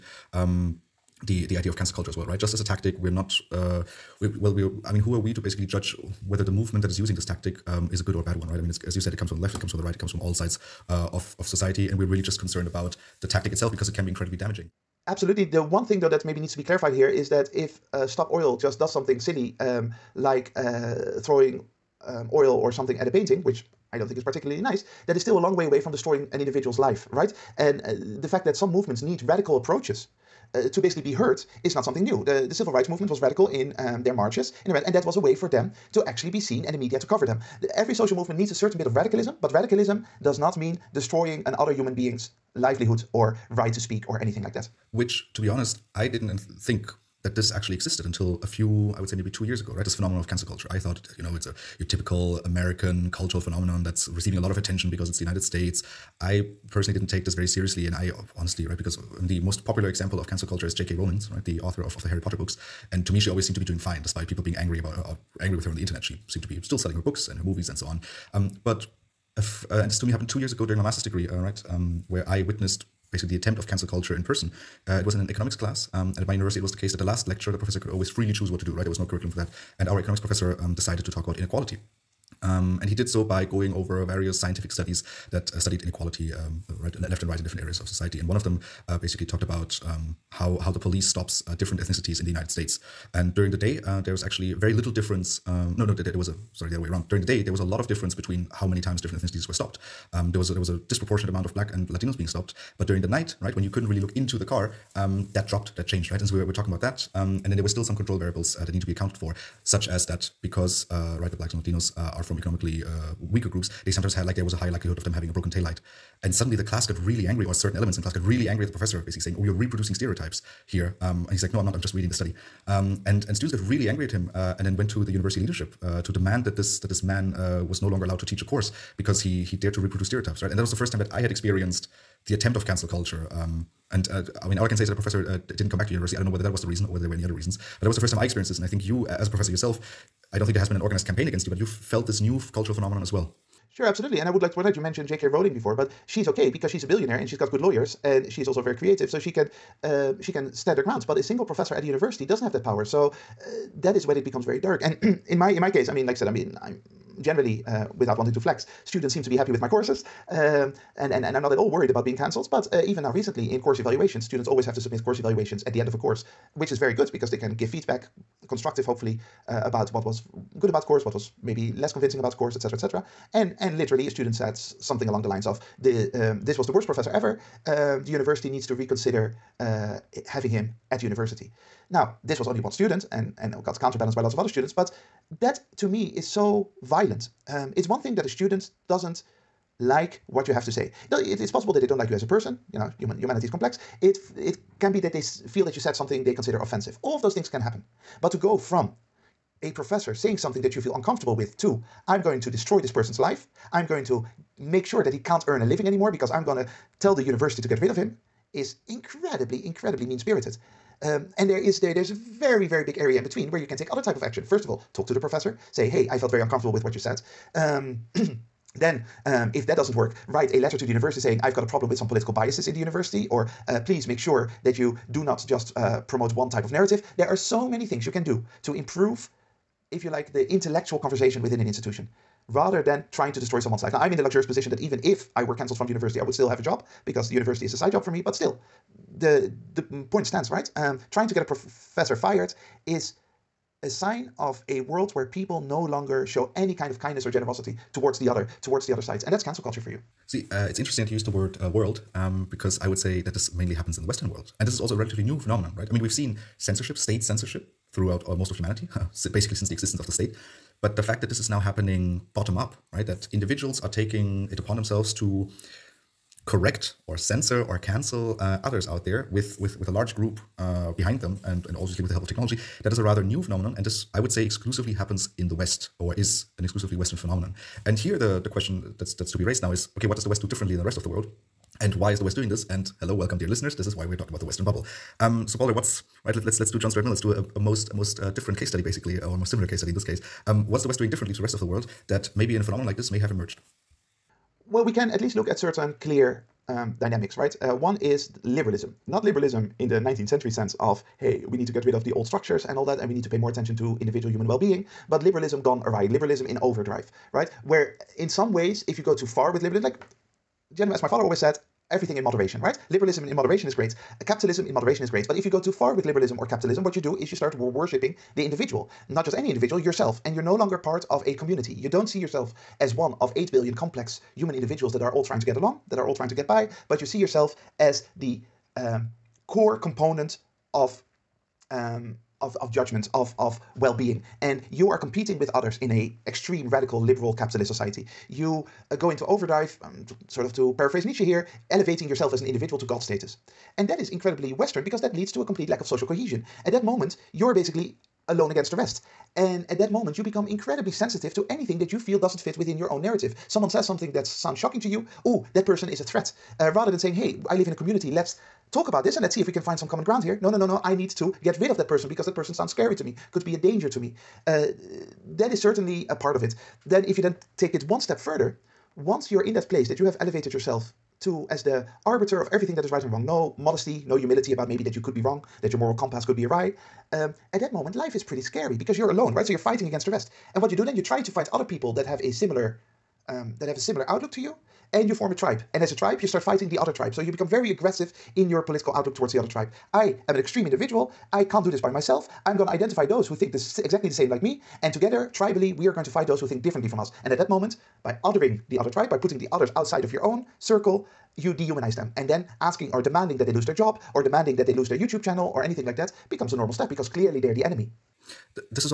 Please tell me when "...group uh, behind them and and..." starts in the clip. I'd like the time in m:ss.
4:30.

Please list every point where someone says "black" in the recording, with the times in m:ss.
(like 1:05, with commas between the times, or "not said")
1:41, 1:51.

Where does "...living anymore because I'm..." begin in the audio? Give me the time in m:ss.
3:25.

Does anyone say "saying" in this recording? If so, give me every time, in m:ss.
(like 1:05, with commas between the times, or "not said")
1:59, 3:20, 3:41, 5:56.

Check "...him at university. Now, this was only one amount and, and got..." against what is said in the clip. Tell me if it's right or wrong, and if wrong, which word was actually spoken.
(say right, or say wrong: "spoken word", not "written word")
wrong: "student", not "amount".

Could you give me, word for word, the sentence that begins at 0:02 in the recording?
Just as a tactic, we're not.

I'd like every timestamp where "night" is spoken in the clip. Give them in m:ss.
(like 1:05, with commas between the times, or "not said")
1:43.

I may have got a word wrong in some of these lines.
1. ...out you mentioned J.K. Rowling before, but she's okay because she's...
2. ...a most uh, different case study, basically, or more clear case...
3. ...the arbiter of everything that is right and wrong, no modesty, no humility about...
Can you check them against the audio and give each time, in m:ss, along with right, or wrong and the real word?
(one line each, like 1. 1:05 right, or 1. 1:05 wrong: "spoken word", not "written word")
1. 2:24 right
2. 4:47 wrong: "similar", not "clear"
3. 6:11 right.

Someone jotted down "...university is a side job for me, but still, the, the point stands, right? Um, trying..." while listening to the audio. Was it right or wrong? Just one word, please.
right.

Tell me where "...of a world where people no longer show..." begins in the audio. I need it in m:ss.
4:04.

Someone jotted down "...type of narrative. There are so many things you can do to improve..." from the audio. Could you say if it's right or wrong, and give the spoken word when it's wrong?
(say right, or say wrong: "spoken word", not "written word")
right.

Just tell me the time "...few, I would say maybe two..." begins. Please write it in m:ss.
0:48.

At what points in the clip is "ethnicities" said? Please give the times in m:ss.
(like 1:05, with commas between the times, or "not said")
1:31, 1:39.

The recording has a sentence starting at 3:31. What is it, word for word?
Um, and there is there there's a very very big area in between where you can take other type of action.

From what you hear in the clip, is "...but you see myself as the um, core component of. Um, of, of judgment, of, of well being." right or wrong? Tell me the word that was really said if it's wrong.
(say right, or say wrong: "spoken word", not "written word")
wrong: "yourself", not "myself".